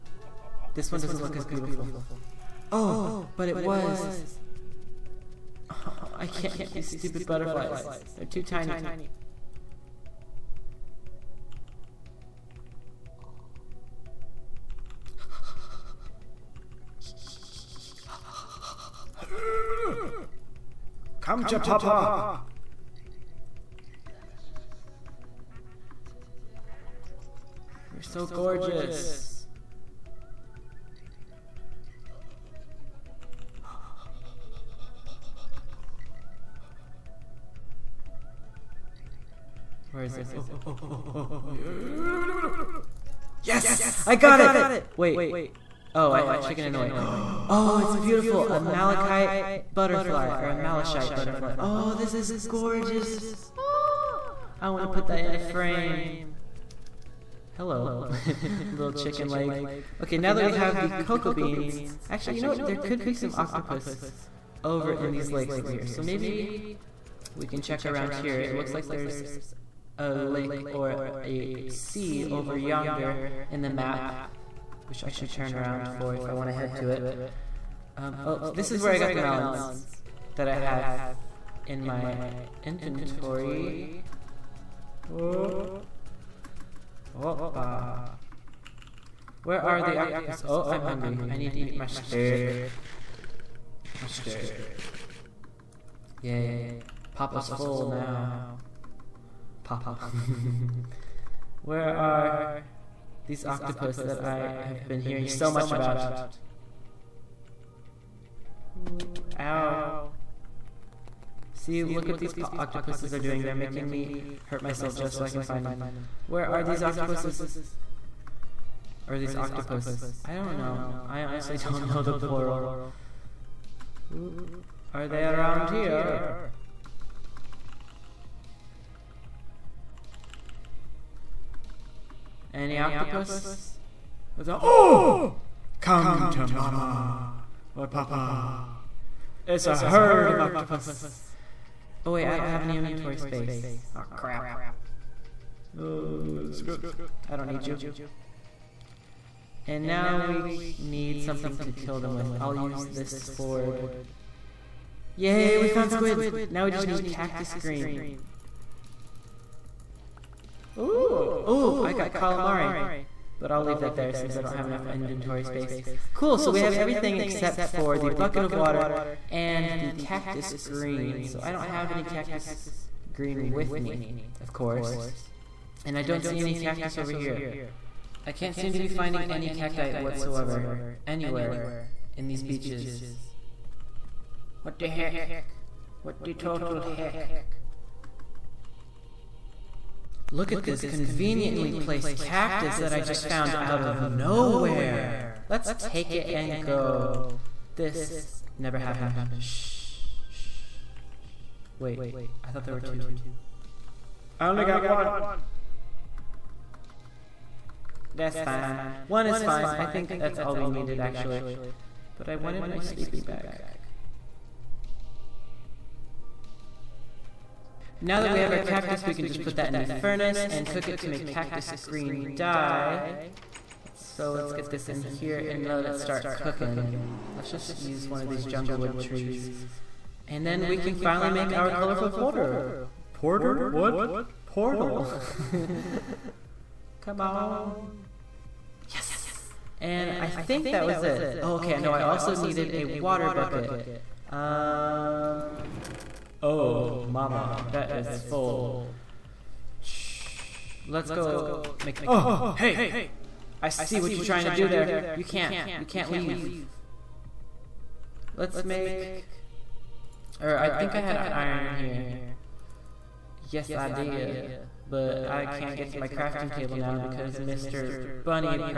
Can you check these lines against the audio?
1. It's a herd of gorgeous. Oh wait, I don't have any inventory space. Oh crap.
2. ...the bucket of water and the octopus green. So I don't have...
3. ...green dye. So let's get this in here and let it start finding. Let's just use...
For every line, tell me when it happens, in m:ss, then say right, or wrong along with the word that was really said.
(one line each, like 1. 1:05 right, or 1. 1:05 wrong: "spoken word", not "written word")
1. 2:19 wrong: "octopus", not "gorgeous"
2. 2:47 wrong: "cactus", not "octopus"
3. 3:41 wrong: "cooking", not "finding".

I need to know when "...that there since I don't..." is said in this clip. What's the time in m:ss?
2:43.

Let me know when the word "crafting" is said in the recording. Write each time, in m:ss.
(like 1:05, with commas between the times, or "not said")
4:26.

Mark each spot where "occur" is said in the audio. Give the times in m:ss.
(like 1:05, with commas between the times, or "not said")
not said.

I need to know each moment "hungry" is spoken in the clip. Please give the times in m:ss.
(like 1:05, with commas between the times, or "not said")
1:30.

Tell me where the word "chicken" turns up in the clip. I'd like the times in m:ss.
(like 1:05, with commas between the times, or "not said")
0:46, 0:58.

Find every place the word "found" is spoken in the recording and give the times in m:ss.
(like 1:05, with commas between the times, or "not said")
2:35, 3:13.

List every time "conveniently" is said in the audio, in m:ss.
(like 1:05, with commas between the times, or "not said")
3:10.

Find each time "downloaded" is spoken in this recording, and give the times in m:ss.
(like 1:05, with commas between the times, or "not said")
not said.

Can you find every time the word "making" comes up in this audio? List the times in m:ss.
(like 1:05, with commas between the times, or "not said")
1:53.